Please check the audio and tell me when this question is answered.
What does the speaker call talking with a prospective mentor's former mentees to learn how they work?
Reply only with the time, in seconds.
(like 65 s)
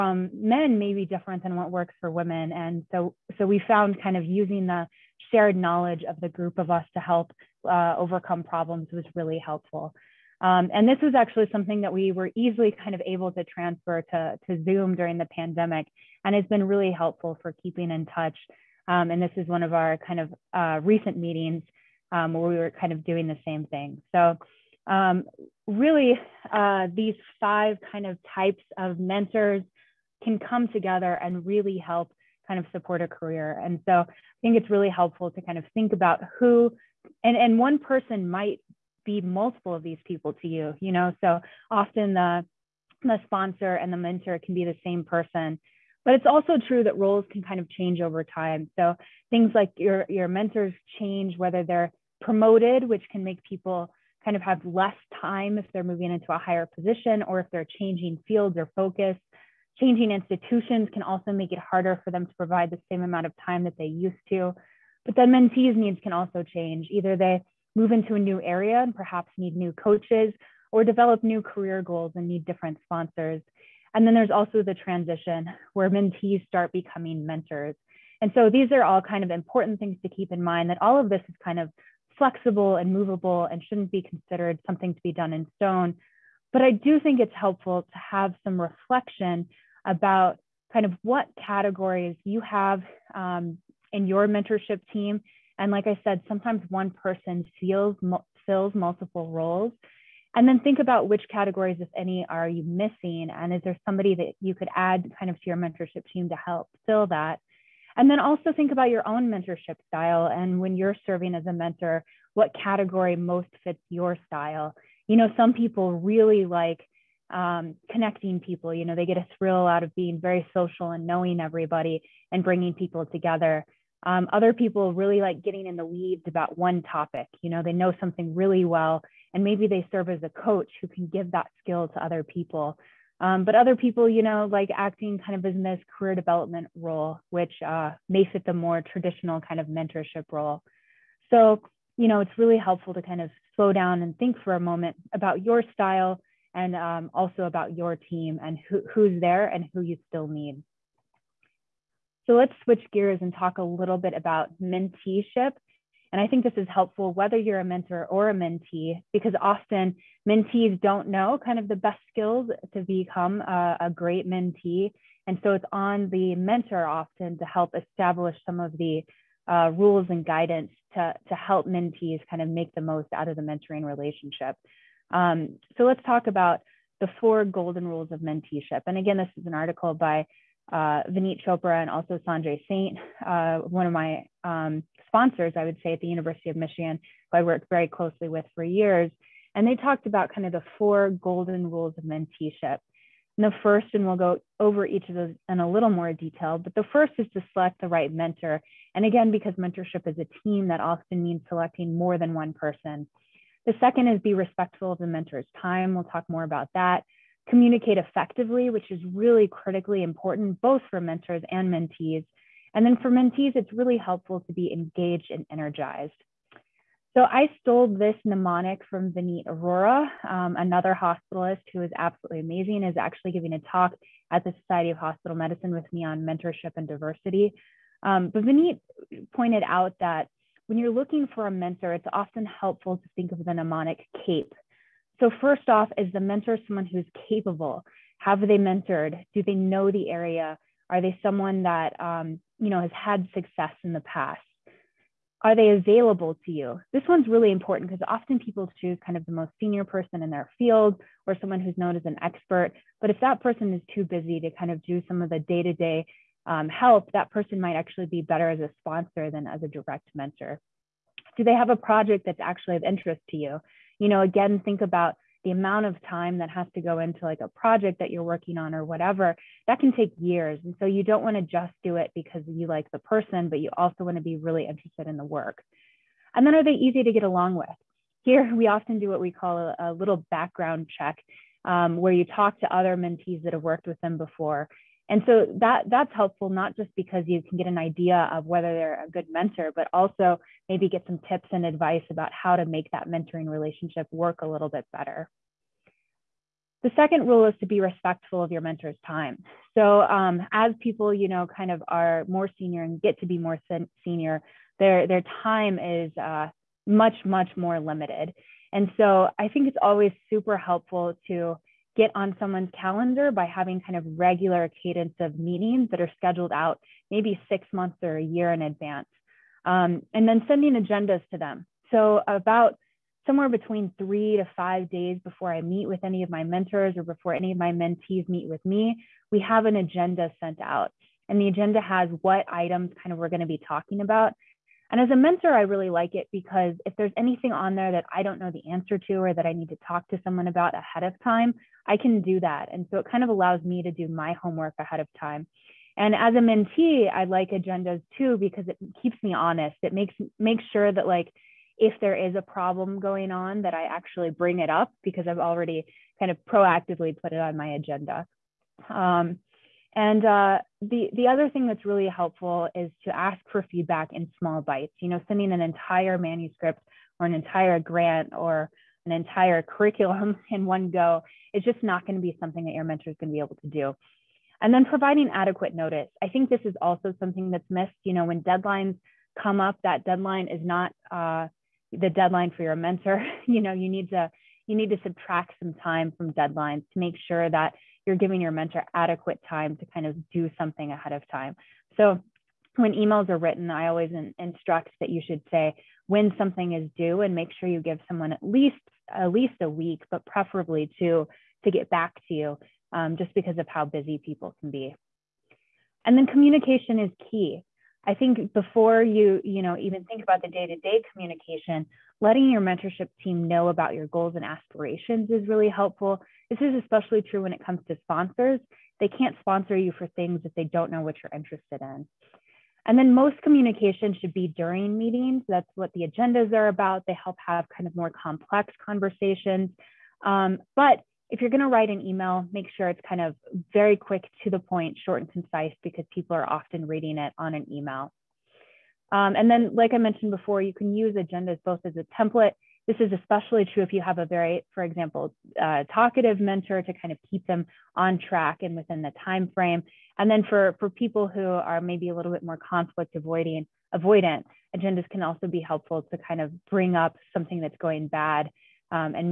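280 s.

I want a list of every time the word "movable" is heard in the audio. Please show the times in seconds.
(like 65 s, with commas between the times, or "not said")
82 s.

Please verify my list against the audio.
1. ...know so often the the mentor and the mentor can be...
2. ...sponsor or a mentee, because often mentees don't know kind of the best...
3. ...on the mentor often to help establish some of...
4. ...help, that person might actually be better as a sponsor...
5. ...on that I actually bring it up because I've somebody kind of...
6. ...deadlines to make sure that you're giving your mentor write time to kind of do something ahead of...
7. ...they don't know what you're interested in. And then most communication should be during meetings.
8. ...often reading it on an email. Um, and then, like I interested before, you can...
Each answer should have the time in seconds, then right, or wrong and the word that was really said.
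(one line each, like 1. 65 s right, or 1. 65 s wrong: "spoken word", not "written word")
1. 40 s wrong: "sponsor", not "mentor"
2. 157 s wrong: "mentor", not "sponsor"
3. 165 s right
4. 256 s right
5. 353 s wrong: "already", not "somebody"
6. 386 s wrong: "adequate", not "write"
7. 420 s right
8. 436 s wrong: "mentioned", not "interested".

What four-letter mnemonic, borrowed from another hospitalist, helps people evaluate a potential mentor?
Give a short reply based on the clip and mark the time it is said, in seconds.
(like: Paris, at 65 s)
CAPE, at 234 s.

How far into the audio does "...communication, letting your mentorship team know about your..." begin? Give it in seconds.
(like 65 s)
411 s.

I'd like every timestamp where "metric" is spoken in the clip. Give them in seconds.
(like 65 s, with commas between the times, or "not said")
not said.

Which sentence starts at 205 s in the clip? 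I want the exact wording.
We'll talk more about that communicate effectively, which is really critically important, both for mentors and mentees.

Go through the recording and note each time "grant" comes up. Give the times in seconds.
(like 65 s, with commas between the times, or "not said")
367 s.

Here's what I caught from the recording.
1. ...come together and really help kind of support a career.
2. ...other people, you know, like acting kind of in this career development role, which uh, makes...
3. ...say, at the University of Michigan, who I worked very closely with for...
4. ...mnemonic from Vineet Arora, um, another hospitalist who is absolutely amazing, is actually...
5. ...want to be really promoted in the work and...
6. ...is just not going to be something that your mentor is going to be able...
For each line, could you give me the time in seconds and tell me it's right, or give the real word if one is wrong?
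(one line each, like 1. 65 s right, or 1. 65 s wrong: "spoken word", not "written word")
1. 30 s right
2. 133 s right
3. 185 s right
4. 218 s right
5. 274 s wrong: "interested", not "promoted"
6. 371 s right.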